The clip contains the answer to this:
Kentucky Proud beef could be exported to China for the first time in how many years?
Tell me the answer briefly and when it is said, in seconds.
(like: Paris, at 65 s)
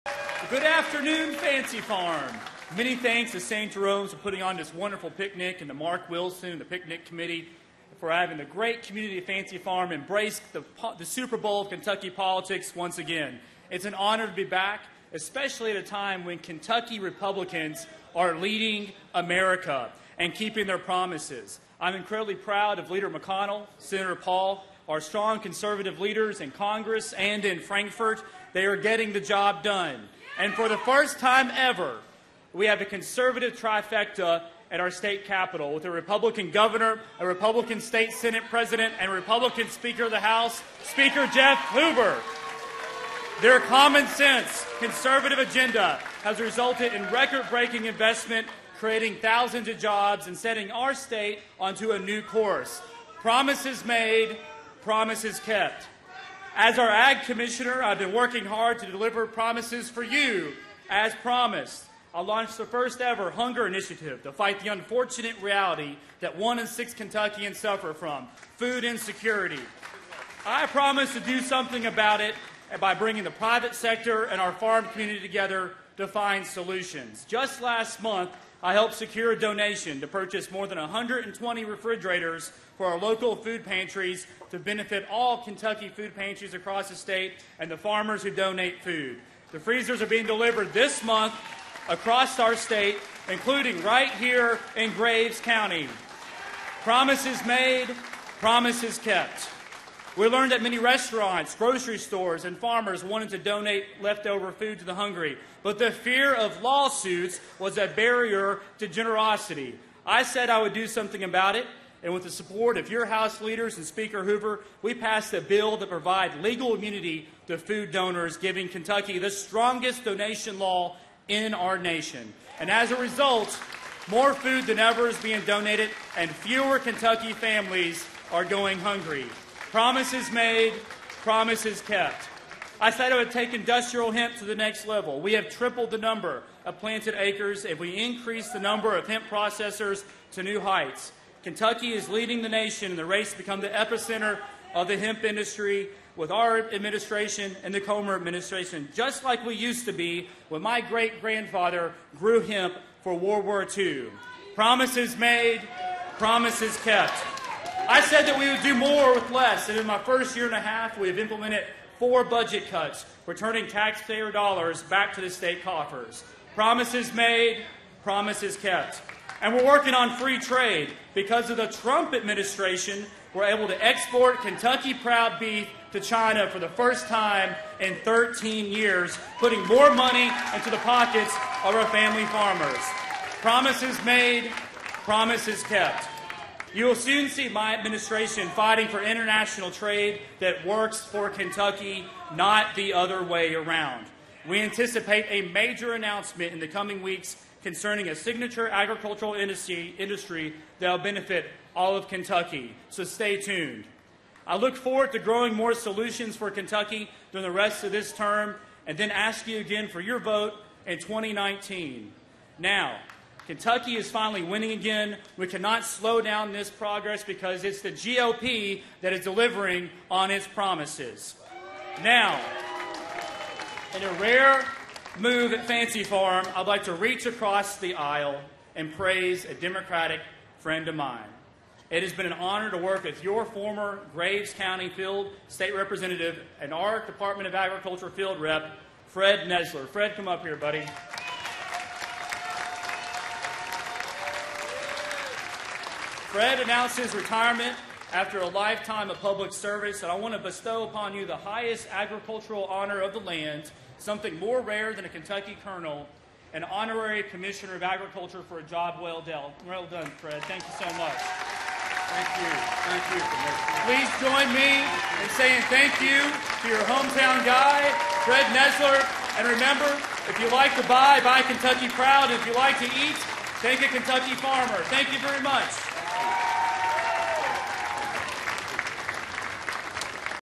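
13, at 178 s.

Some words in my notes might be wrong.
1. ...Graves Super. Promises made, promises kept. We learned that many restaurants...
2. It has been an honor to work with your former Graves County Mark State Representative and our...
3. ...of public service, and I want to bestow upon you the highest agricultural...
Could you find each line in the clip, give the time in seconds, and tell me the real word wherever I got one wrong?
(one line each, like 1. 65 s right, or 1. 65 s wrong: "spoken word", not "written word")
1. 94 s wrong: "County", not "Super"
2. 231 s wrong: "Field", not "Mark"
3. 249 s right.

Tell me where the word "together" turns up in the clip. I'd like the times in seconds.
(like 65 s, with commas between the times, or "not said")
75 s.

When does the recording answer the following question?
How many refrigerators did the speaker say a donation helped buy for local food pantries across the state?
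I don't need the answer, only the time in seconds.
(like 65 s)
80 s.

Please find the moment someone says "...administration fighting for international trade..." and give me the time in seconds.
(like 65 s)
187 s.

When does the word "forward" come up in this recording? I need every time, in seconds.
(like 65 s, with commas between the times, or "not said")
204 s.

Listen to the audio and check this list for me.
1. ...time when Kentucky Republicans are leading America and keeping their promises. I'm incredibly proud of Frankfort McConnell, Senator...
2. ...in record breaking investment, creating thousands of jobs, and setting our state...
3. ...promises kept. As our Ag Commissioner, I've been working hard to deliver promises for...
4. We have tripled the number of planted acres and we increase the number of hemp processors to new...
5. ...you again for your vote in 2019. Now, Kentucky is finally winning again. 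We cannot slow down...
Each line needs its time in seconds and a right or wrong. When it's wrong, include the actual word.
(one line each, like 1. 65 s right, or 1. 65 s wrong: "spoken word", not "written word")
1. 15 s wrong: "Leader", not "Frankfort"
2. 46 s right
3. 54 s right
4. 135 s right
5. 209 s right.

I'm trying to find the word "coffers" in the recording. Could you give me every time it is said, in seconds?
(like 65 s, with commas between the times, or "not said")
165 s.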